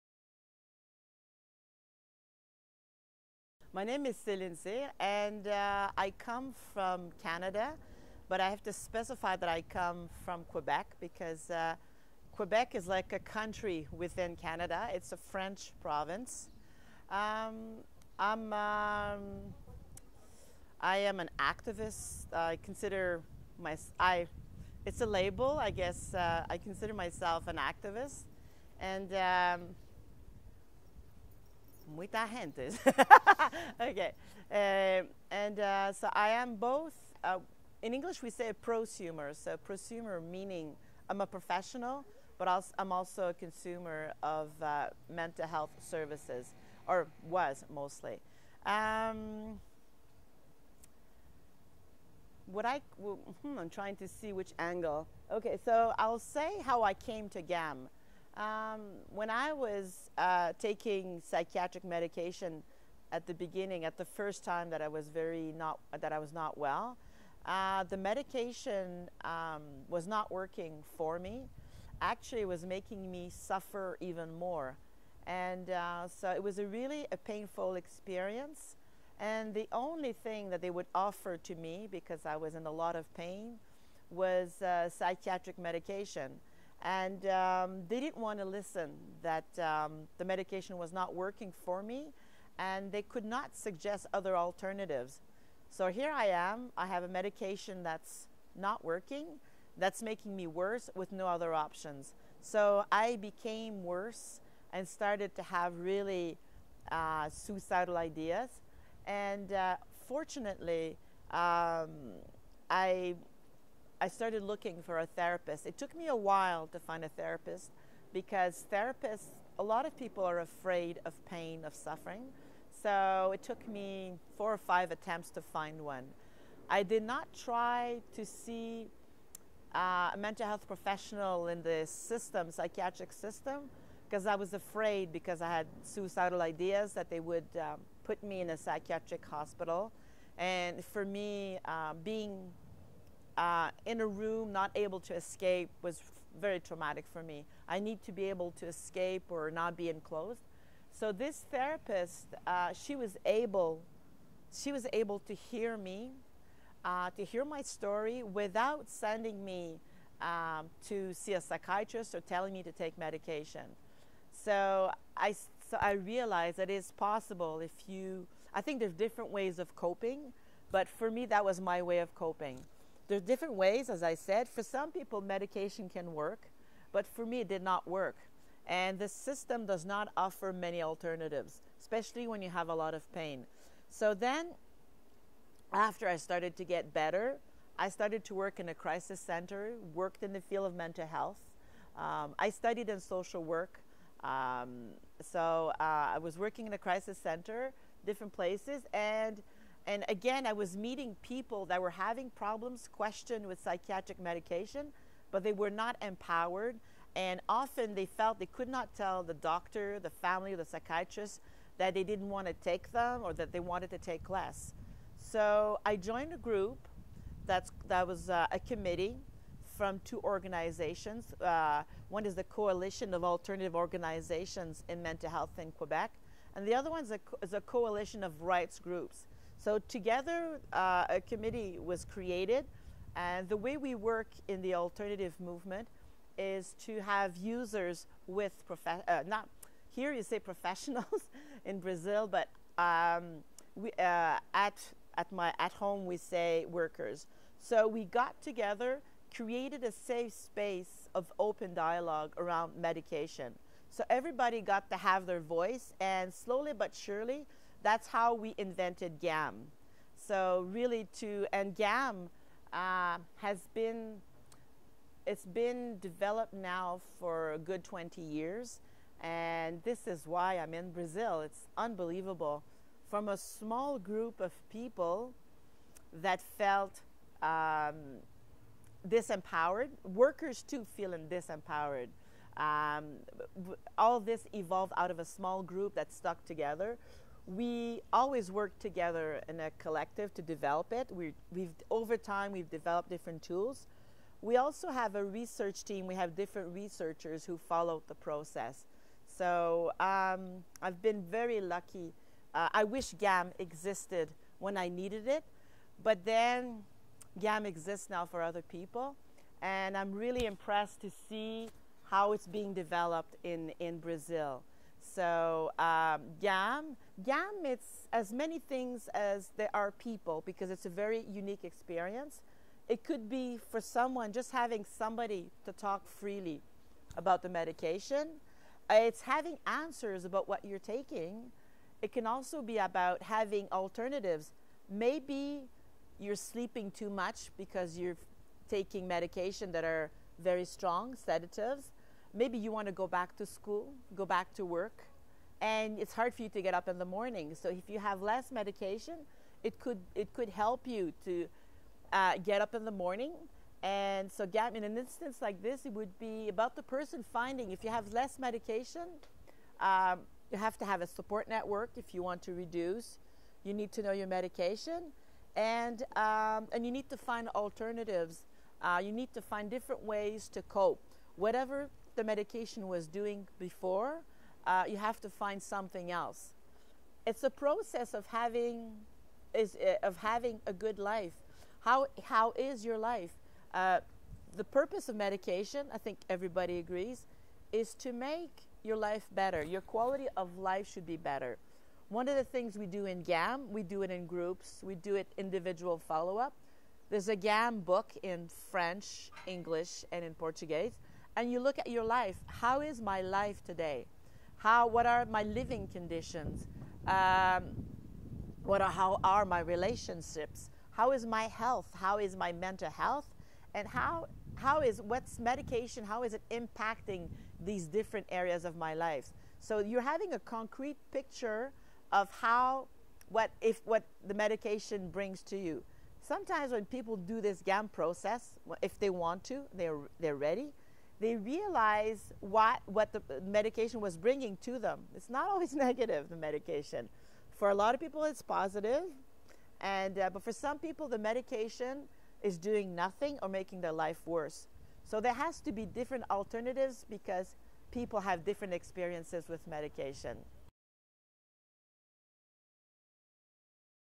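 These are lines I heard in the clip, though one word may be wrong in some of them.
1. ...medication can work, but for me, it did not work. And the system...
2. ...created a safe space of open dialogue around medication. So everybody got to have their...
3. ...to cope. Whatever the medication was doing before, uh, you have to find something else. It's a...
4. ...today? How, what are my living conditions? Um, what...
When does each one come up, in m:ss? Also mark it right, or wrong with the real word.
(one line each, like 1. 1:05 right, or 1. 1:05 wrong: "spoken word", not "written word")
1. 2:55 right
2. 4:09 right
3. 6:10 right
4. 6:43 right.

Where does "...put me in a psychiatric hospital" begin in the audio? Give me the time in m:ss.
2:18.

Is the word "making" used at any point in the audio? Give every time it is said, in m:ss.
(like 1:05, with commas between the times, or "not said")
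1:12, 1:40, 7:23.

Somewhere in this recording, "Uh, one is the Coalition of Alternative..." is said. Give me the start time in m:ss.
3:41.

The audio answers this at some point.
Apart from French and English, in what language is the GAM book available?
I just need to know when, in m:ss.
6:40.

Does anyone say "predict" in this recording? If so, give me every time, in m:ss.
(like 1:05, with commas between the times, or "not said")
not said.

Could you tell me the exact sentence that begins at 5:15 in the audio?
So um, GAM, GAM, it's as many things as there are people because it's a very unique experience.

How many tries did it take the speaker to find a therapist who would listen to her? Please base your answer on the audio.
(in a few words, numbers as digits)
4 or 5.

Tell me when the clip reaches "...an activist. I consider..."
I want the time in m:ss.
0:21.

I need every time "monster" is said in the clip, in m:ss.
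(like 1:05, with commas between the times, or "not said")
not said.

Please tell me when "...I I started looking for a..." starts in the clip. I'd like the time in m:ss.
1:52.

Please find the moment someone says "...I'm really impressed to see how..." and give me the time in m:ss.
5:09.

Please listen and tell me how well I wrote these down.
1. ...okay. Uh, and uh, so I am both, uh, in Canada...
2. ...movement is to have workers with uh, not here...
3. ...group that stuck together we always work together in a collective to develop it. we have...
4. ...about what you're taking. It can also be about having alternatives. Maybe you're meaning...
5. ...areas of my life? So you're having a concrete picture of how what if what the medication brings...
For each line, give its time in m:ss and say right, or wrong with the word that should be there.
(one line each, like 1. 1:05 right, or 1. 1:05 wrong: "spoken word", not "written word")
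1. 0:33 wrong: "English", not "Canada"
2. 3:55 wrong: "users", not "workers"
3. 4:45 right
4. 5:30 wrong: "sleeping", not "meaning"
5. 6:58 right.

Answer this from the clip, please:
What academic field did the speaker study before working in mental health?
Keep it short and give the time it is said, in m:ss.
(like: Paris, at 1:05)
social work, at 3:13.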